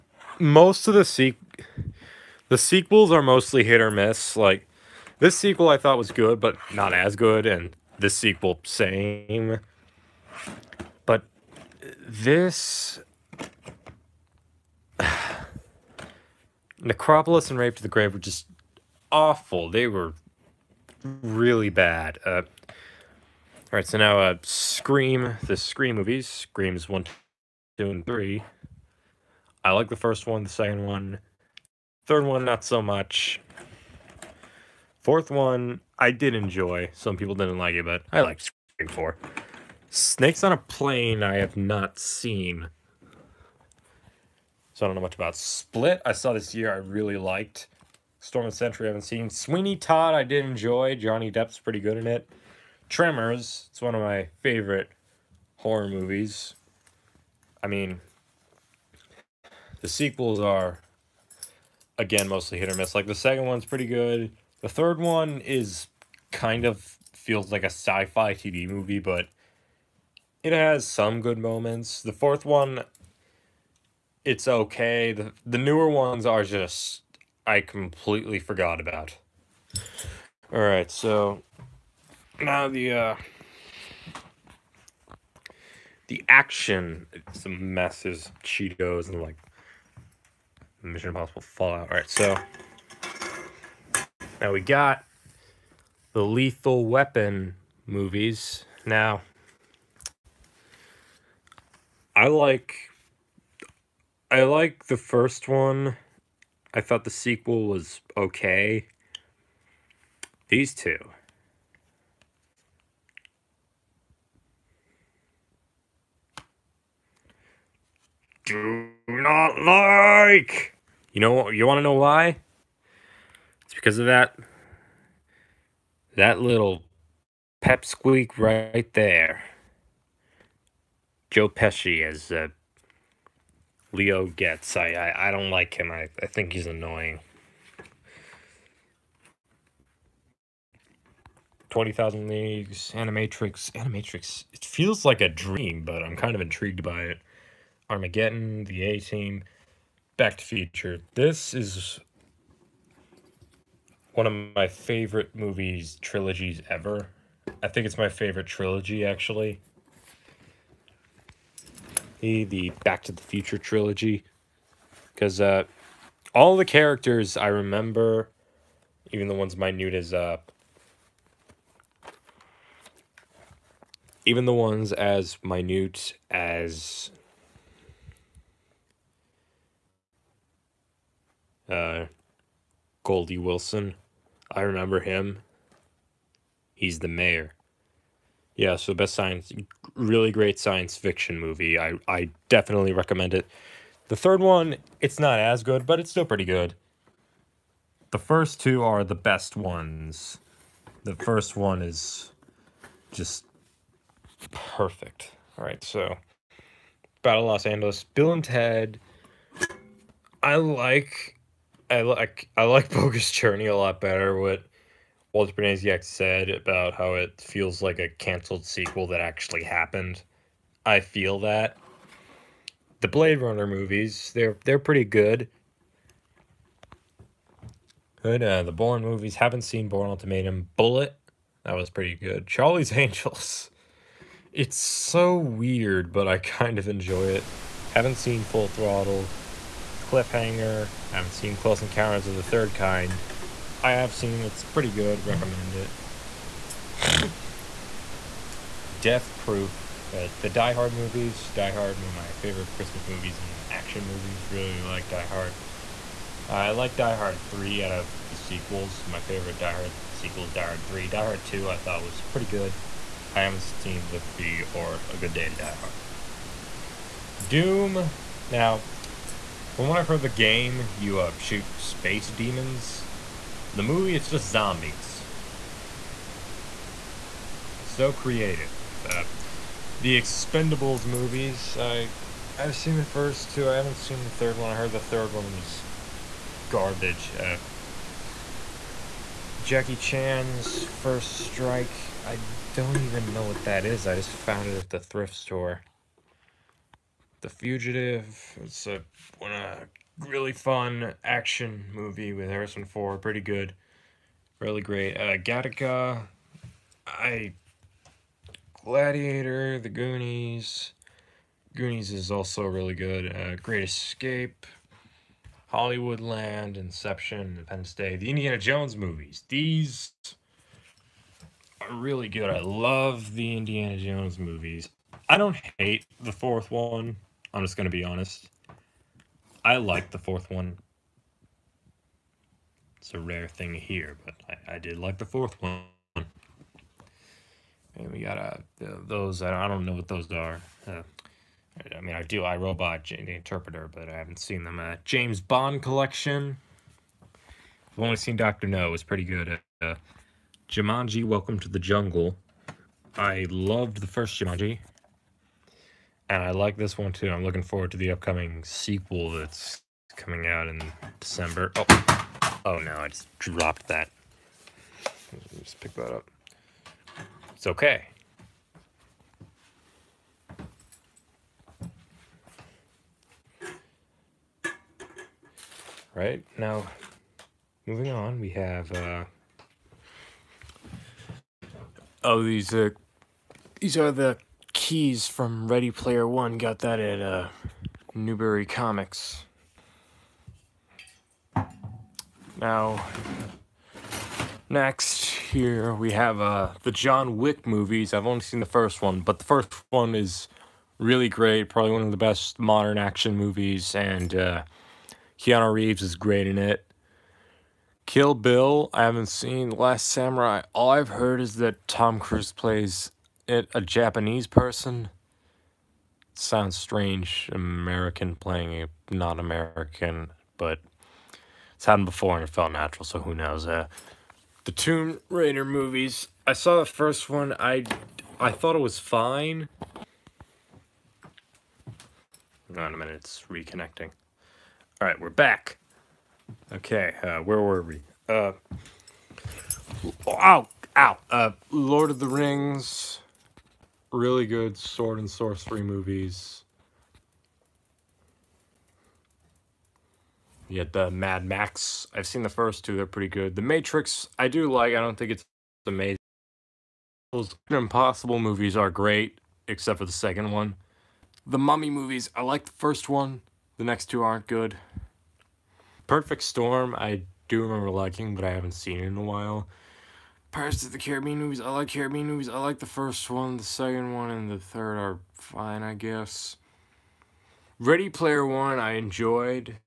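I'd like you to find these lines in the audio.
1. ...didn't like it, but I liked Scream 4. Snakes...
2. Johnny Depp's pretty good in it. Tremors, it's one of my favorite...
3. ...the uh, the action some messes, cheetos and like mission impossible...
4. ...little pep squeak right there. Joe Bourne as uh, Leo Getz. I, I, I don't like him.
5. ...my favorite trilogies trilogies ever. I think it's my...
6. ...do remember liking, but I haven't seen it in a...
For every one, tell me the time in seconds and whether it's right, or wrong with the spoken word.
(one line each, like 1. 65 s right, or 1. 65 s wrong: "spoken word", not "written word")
1. 37 s right
2. 50 s right
3. 82 s right
4. 126 s wrong: "Pesci", not "Bourne"
5. 154 s wrong: "movies", not "trilogies"
6. 467 s right.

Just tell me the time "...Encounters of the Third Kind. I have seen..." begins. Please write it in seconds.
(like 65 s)
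241 s.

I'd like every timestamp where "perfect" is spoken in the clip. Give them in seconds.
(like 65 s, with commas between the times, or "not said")
204 s, 466 s.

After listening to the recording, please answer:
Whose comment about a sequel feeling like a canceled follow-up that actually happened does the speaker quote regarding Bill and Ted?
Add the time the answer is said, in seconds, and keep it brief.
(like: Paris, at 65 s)
Walter Benesiak, at 215 s.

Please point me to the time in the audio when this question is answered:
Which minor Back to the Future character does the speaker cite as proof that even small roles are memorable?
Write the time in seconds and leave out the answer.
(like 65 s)
183 s.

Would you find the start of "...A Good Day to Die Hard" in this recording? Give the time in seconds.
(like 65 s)
265 s.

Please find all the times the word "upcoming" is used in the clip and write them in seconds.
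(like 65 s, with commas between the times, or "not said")
358 s.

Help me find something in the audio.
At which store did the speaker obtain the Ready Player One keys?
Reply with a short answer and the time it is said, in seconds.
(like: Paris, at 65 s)
Newbury Comics, at 388 s.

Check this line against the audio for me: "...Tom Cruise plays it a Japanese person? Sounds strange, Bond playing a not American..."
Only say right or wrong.
wrong.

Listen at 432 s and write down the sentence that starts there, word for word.
Hang on a minute, it's reconnecting.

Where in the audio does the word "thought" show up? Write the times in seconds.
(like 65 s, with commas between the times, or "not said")
5 s, 106 s, 261 s, 428 s.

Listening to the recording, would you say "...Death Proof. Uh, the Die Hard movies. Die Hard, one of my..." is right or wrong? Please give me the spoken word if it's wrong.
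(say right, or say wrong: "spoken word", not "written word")
right.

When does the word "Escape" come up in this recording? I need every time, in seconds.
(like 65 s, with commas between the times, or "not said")
313 s.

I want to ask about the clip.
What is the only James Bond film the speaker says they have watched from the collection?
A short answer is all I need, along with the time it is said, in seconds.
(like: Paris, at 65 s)
Doctor No, at 348 s.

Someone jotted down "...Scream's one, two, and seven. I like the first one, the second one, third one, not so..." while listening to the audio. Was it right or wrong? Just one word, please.
wrong.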